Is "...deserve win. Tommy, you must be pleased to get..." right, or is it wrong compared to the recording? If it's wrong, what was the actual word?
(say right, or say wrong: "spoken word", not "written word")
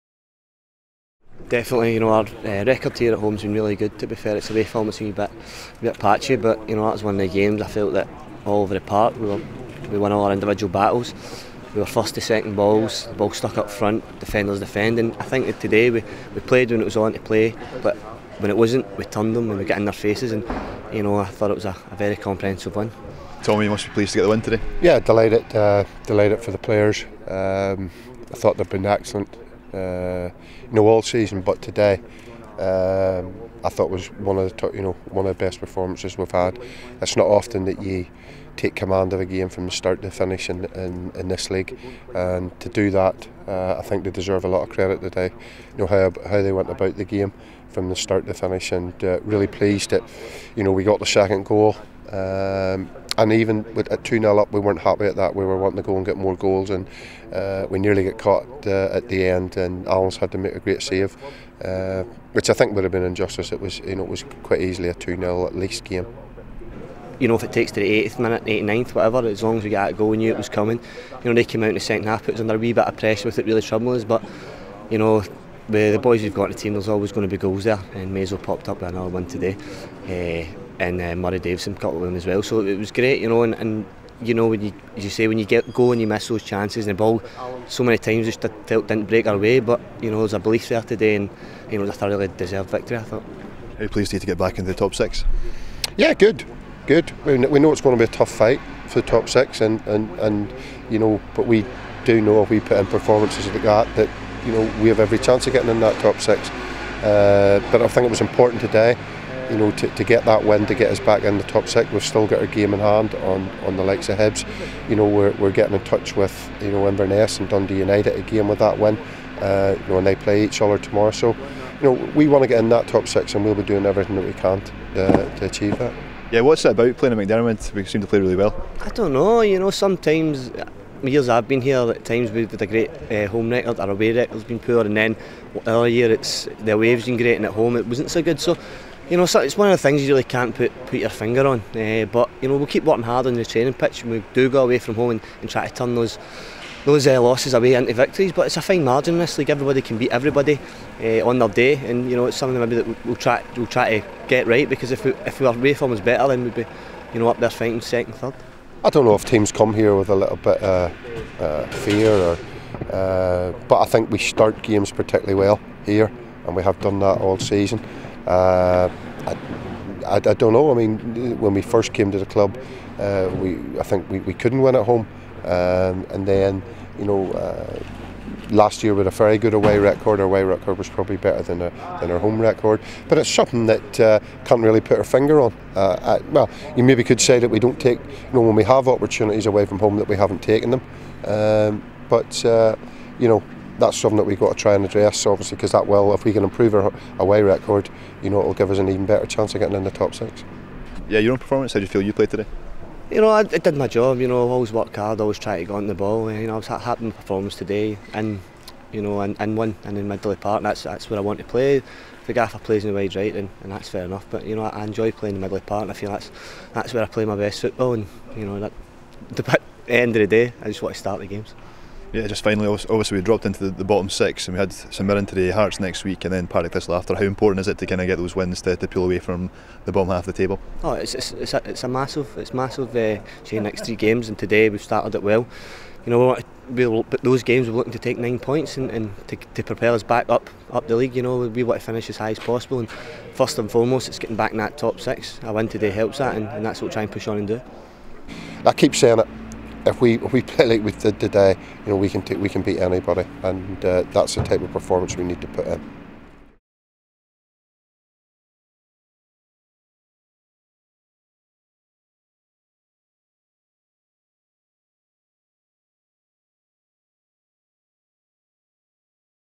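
wrong: "comprehensive", not "deserve".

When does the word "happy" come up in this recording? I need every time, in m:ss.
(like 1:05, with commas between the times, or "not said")
0:54, 3:26.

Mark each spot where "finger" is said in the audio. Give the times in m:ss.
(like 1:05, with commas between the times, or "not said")
2:21, 3:05.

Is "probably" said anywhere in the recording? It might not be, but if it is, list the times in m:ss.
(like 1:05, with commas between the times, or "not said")
3:00.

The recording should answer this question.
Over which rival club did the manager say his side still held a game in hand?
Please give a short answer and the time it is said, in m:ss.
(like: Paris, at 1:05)
Hibs, at 1:54.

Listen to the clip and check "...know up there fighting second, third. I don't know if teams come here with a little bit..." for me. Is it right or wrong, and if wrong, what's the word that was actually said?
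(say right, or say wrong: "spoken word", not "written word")
right.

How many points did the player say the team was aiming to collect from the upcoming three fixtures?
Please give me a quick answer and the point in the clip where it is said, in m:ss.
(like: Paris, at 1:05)
9, at 3:58.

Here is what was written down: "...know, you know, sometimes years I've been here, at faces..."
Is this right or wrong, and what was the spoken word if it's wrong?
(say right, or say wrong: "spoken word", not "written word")
wrong: "times", not "faces".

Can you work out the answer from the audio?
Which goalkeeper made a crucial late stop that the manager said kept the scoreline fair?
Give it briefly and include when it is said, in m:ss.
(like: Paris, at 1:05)
Allen, at 0:59.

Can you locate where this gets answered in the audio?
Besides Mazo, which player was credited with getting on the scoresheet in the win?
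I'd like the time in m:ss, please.
1:21.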